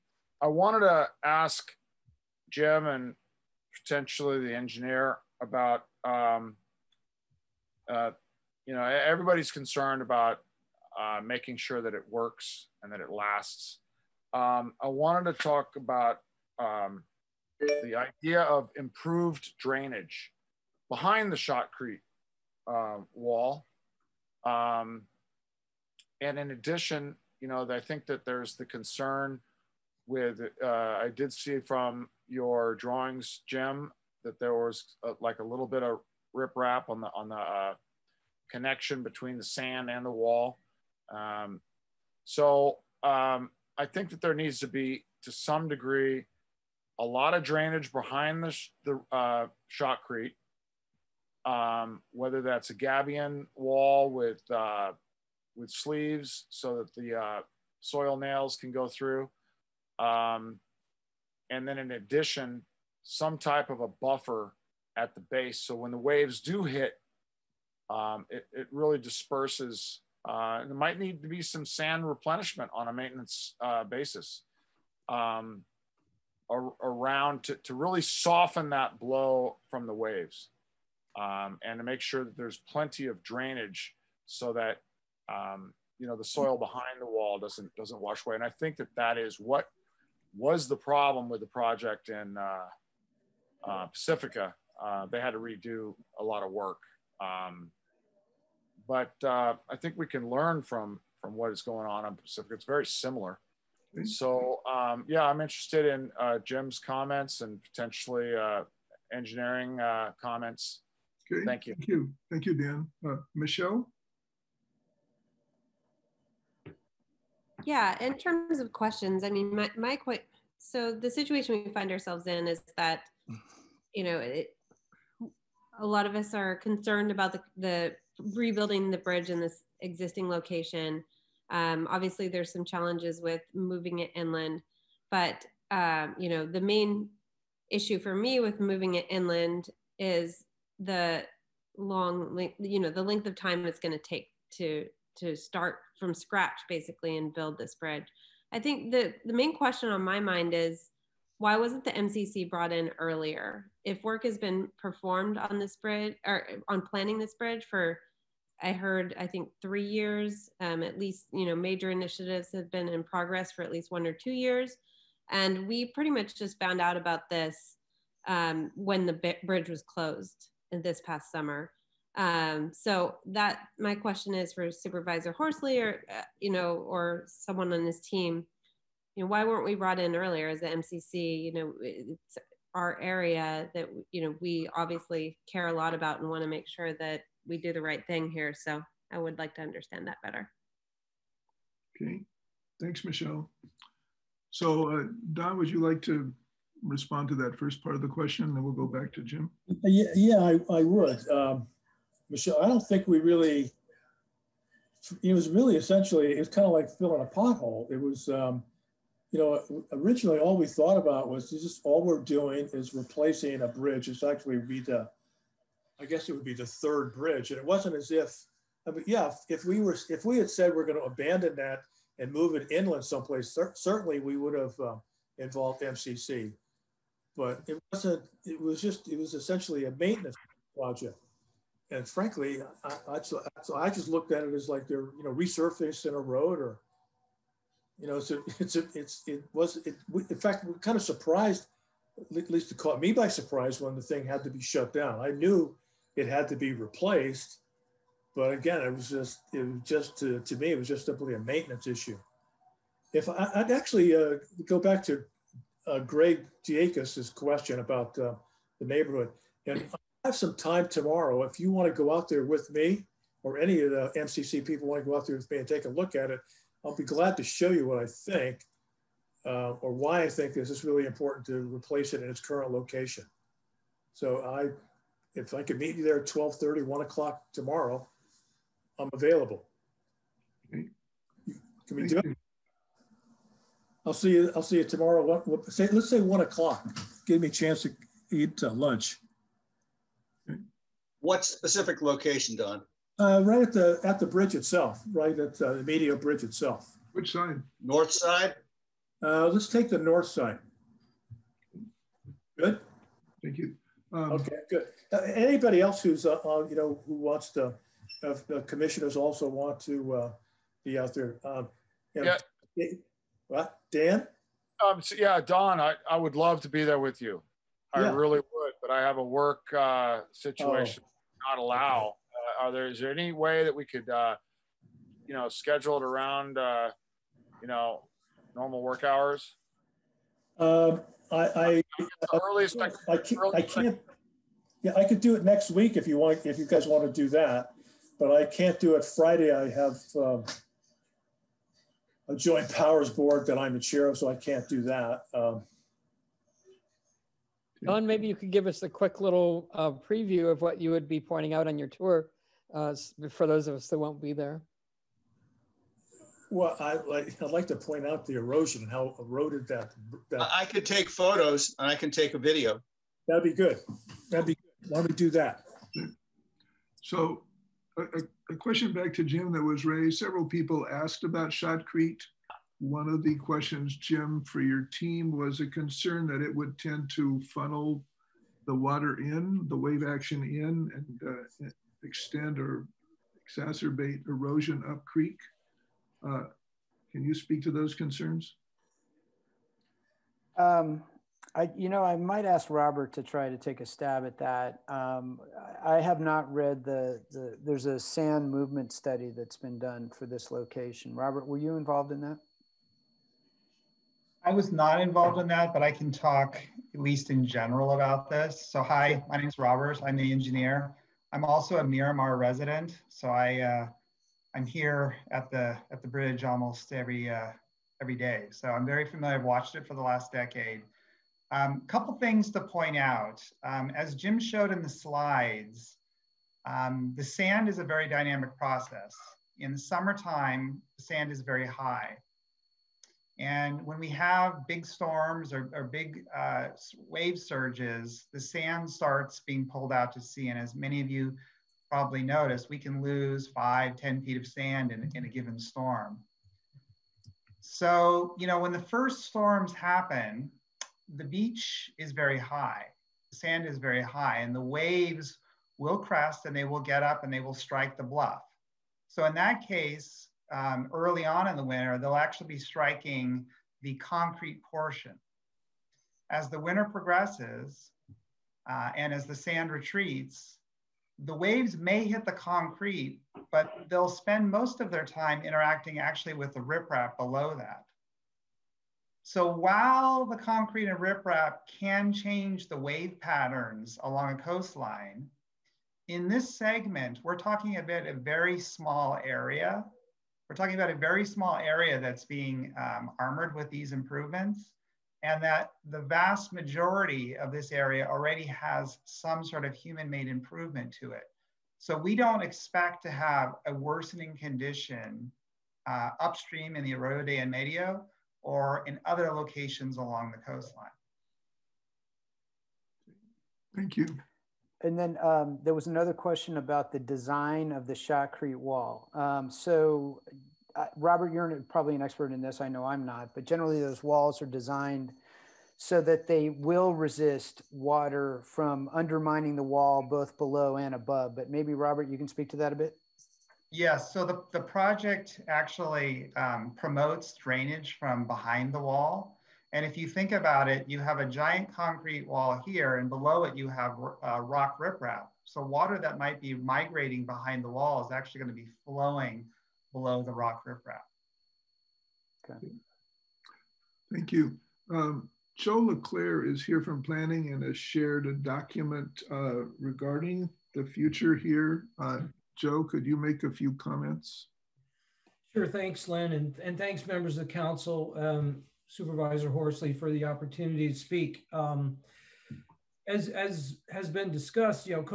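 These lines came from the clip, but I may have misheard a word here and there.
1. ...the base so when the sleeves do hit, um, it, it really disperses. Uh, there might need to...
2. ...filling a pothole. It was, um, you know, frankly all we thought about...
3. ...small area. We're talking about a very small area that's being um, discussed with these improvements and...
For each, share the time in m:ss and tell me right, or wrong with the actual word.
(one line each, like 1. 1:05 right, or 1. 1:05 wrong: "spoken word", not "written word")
1. 1:05 wrong: "waves", not "sleeves"
2. 3:26 wrong: "originally", not "frankly"
3. 8:08 wrong: "armored", not "discussed".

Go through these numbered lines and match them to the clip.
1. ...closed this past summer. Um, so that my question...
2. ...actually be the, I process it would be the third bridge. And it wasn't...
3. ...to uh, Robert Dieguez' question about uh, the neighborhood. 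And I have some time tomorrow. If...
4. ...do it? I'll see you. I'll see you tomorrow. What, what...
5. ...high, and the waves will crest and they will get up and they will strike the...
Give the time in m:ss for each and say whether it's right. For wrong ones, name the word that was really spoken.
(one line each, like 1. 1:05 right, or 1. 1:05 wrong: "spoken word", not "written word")
1. 2:49 right
2. 3:34 wrong: "guess", not "process"
3. 4:15 wrong: "Greg", not "Robert"
4. 4:42 right
5. 7:34 right.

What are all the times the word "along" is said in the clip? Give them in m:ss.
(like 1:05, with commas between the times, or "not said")
8:04, 8:29.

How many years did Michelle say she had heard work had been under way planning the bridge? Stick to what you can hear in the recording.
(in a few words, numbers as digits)
3.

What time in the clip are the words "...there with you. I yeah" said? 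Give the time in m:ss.
5:16.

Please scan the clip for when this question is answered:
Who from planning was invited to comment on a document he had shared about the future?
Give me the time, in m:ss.
9:15.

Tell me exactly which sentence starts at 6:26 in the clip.
Uh, can you speak to those concerns?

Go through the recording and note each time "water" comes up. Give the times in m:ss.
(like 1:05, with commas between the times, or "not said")
6:18, 8:47, 9:05.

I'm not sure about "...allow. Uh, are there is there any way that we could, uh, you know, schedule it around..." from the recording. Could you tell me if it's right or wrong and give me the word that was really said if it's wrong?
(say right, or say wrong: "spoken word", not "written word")
right.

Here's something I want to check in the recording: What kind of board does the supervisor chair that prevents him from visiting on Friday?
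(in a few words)
joint powers board.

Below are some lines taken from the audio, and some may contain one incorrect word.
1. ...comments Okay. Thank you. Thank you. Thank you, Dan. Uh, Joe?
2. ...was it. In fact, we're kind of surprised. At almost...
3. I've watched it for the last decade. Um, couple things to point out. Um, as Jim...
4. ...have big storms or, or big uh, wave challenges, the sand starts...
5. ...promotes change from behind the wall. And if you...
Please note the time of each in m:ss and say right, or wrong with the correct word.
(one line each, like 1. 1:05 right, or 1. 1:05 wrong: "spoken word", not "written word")
1. 1:50 wrong: "Michelle", not "Joe"
2. 3:59 wrong: "least", not "almost"
3. 6:59 right
4. 7:14 wrong: "surges", not "challenges"
5. 8:56 wrong: "drainage", not "change".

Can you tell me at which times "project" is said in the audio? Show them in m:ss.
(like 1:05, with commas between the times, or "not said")
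1:31, 3:50, 8:54.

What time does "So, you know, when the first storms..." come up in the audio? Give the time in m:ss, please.
7:27.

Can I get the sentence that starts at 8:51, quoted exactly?
But maybe Robert, you can speak to that a bit.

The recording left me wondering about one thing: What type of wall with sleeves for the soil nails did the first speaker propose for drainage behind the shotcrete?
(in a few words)
gabion wall.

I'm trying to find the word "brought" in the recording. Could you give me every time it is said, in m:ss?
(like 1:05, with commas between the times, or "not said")
2:32, 2:59.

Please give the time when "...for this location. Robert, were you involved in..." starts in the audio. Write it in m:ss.
6:40.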